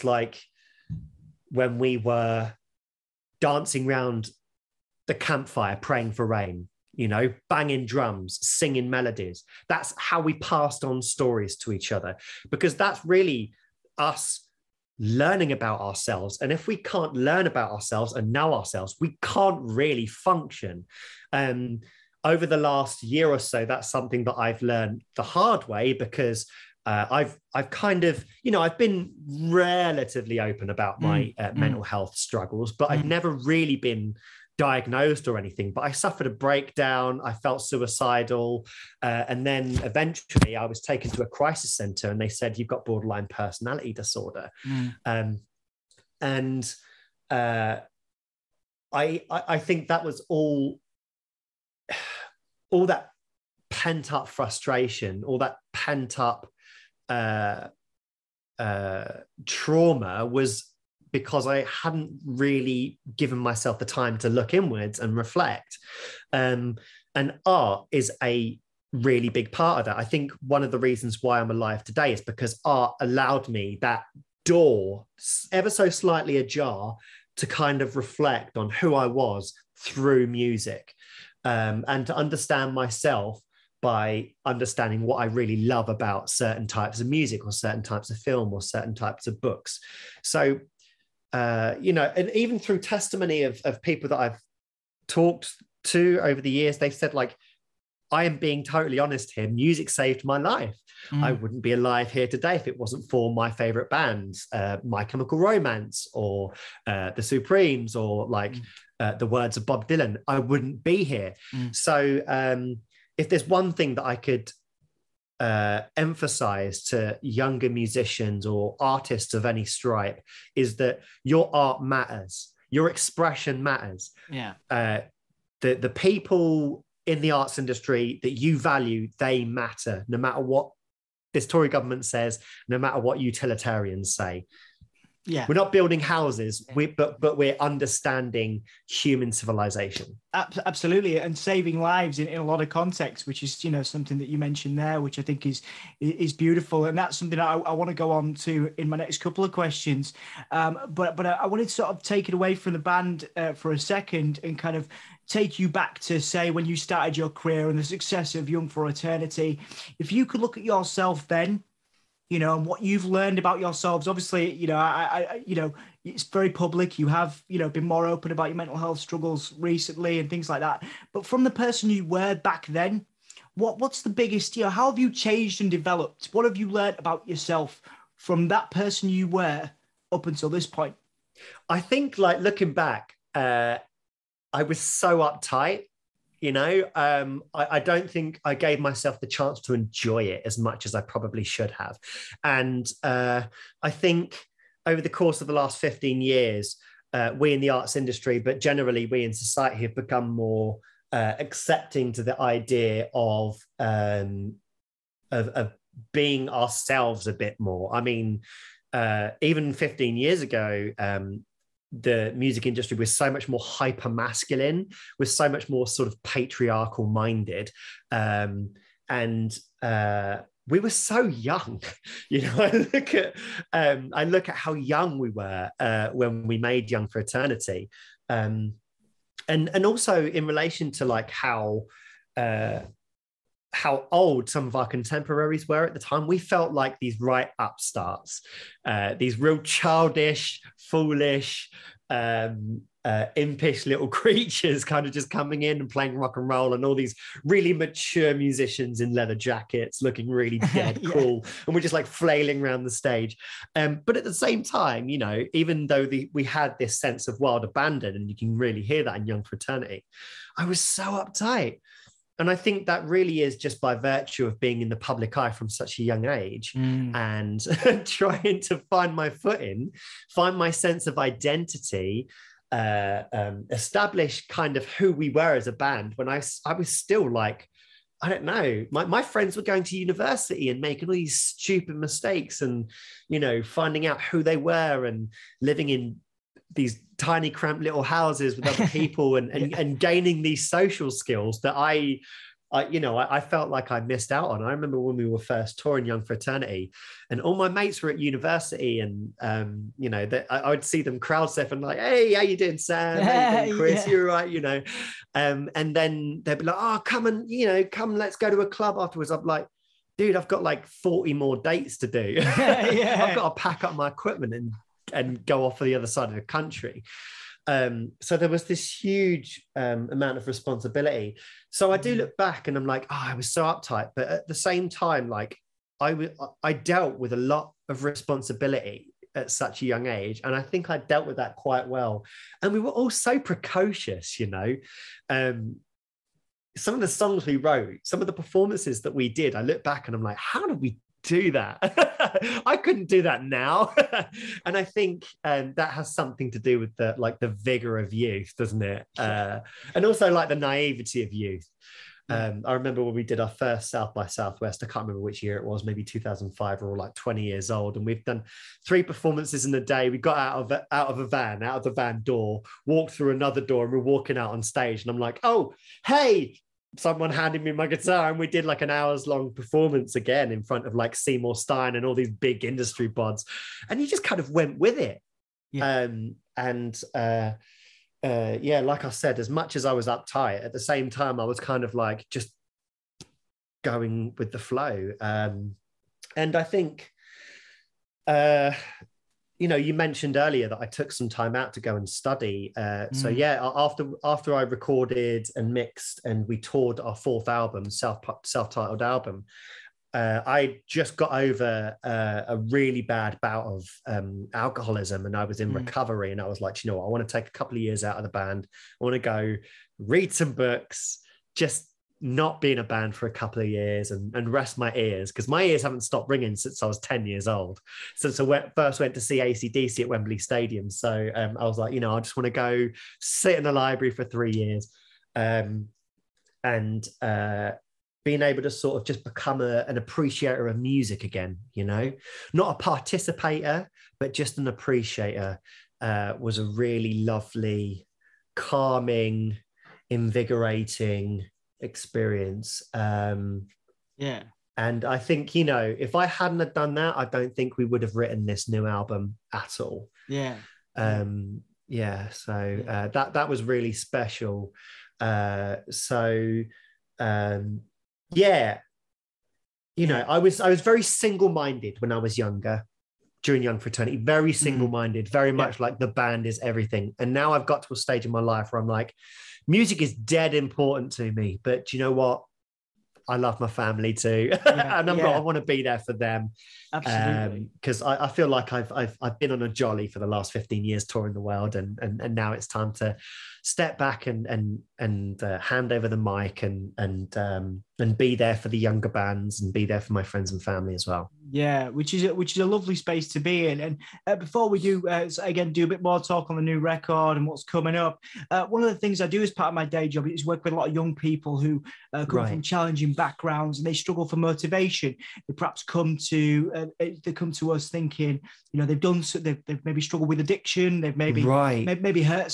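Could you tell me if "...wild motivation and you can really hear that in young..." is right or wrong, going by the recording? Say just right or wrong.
wrong.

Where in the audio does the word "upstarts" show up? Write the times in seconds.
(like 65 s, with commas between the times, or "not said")
237 s.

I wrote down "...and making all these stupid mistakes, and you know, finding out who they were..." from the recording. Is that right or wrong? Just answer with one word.
right.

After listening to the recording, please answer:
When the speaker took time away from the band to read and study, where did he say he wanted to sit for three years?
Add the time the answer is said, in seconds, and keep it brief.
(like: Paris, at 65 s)
The library, at 423 s.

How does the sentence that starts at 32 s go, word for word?
I've never really been diagnosed or anything, but I suffered a breakdown.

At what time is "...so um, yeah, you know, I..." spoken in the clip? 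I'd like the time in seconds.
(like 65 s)
455 s.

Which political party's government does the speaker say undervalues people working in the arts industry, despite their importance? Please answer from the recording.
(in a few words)
Tory.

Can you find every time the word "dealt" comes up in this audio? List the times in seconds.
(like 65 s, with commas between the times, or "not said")
326 s, 330 s.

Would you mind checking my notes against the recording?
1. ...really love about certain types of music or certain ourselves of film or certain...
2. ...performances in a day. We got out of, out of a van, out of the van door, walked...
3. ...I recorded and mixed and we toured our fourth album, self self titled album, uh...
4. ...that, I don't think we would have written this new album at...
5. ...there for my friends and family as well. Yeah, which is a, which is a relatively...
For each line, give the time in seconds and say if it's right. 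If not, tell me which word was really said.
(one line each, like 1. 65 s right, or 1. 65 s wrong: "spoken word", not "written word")
1. 85 s wrong: "types", not "ourselves"
2. 359 s right
3. 394 s right
4. 446 s right
5. 489 s wrong: "lovely", not "relatively".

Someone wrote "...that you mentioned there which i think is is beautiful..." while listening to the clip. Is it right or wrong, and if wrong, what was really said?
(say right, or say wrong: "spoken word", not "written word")
right.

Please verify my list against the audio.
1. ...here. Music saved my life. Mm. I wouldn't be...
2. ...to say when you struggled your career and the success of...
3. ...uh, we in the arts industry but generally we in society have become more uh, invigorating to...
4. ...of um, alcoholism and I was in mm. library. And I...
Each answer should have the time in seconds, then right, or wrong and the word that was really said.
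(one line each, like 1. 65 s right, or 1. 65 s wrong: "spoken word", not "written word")
1. 99 s right
2. 155 s wrong: "started", not "struggled"
3. 197 s wrong: "accepting", not "invigorating"
4. 403 s wrong: "recovery", not "library".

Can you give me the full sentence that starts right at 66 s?
Um, and art is a really big part of that.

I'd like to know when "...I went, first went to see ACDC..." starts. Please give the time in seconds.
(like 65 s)
418 s.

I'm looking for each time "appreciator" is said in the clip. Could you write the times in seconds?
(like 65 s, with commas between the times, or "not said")
429 s, 434 s.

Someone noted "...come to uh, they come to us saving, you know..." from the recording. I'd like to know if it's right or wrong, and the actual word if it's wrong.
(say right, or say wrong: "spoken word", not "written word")
wrong: "thinking", not "saving".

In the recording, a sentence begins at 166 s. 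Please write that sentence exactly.
You have, you know, been more open about your mental health struggles recently and things like that.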